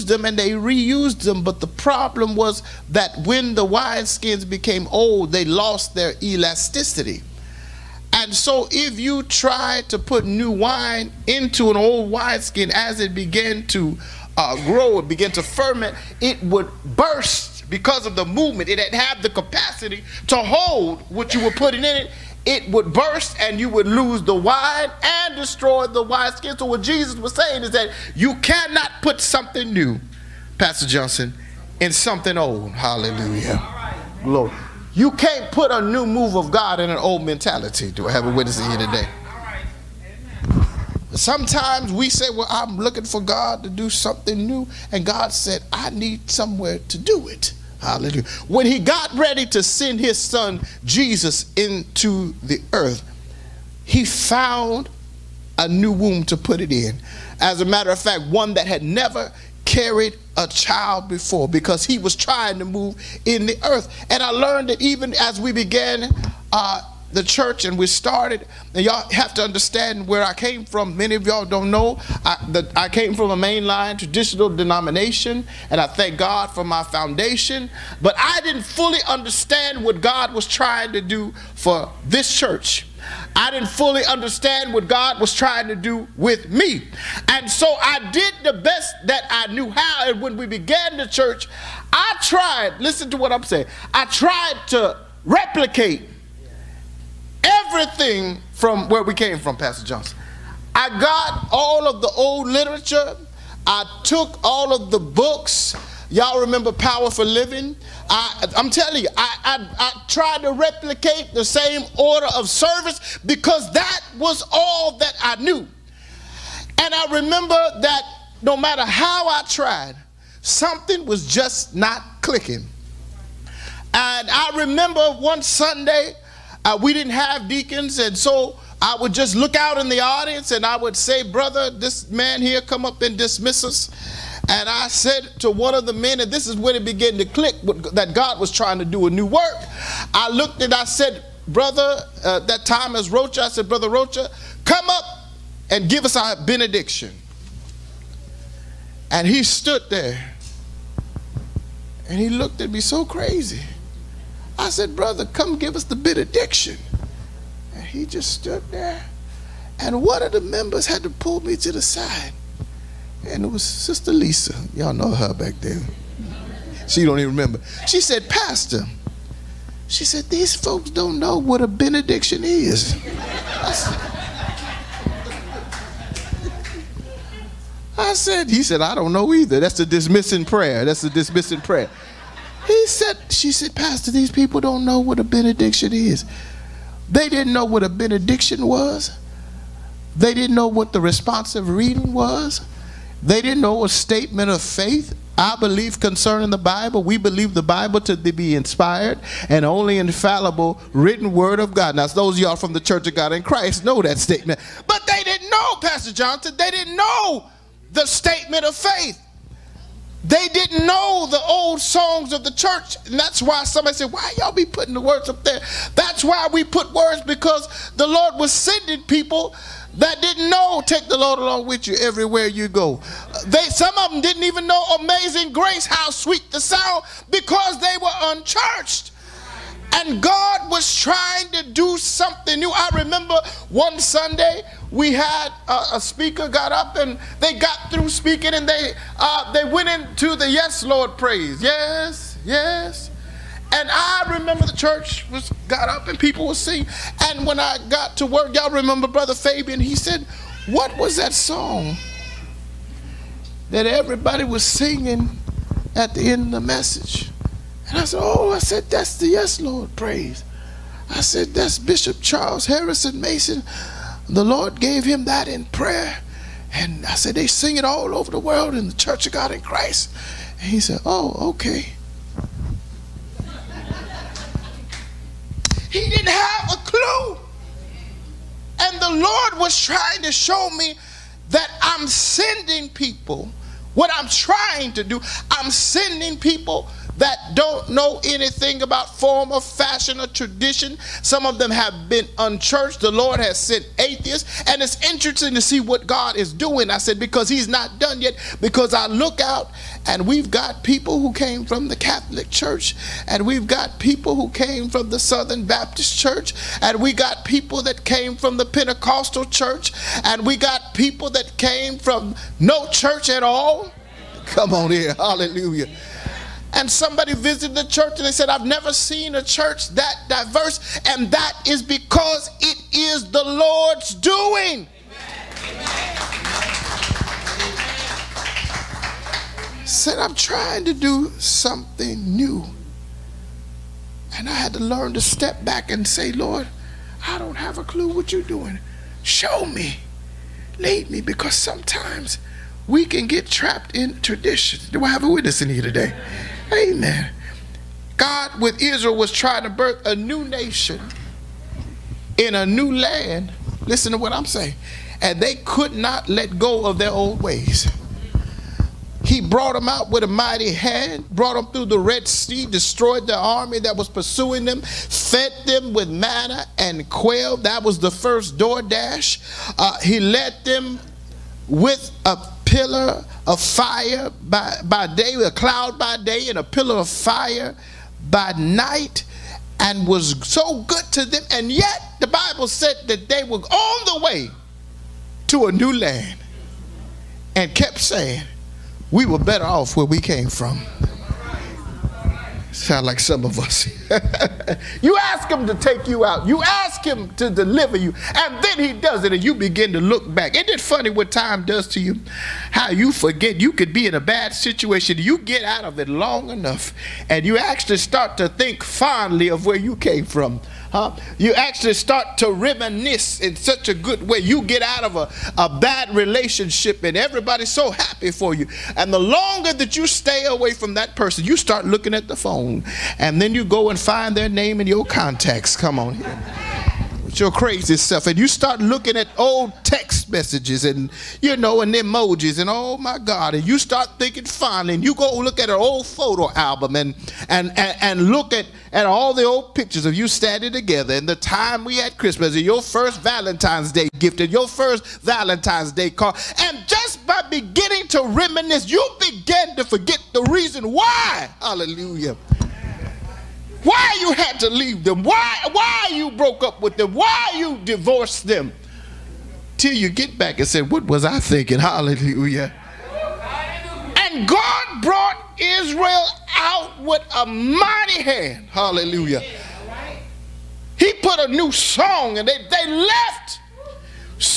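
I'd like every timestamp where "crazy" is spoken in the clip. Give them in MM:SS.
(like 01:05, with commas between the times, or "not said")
02:33, 07:07.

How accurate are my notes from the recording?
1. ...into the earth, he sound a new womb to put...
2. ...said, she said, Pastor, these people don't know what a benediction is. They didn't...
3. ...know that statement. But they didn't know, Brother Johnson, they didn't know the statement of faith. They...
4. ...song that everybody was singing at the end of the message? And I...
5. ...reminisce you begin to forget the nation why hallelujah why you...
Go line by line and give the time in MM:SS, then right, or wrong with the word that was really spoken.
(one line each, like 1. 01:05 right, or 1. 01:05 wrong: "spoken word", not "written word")
1. 00:51 wrong: "found", not "sound"
2. 03:02 right
3. 03:23 wrong: "Pastor", not "Brother"
4. 04:11 right
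5. 07:28 wrong: "reason", not "nation".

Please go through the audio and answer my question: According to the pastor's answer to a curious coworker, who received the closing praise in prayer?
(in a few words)
Bishop Charles Harrison Mason.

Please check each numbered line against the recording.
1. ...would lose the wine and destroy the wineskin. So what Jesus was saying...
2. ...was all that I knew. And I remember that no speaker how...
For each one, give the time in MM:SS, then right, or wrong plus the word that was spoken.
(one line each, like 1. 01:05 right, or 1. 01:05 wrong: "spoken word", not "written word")
1. 00:23 right
2. 01:54 wrong: "matter", not "speaker".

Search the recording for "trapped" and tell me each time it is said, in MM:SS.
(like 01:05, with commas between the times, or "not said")
05:43.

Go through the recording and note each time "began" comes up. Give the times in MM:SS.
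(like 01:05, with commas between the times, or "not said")
00:13, 01:05, 01:30, 02:16.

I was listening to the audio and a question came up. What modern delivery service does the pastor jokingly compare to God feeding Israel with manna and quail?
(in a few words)
DoorDash.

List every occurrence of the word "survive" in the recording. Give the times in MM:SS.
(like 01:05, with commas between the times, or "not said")
not said.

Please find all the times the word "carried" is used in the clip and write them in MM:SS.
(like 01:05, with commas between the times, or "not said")
00:59.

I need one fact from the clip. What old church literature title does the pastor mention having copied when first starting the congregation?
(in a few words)
Power for Living.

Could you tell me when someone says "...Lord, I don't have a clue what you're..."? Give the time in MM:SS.
05:36.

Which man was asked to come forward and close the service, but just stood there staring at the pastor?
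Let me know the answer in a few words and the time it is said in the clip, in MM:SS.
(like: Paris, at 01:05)
Brother Rocha, at 02:23.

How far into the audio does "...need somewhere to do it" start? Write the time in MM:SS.
00:45.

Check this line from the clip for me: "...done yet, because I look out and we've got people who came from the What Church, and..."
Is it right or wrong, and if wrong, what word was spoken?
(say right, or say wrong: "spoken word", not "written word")
wrong: "Catholic", not "What".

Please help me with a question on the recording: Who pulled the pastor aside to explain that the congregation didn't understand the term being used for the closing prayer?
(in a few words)
Sister Lisa.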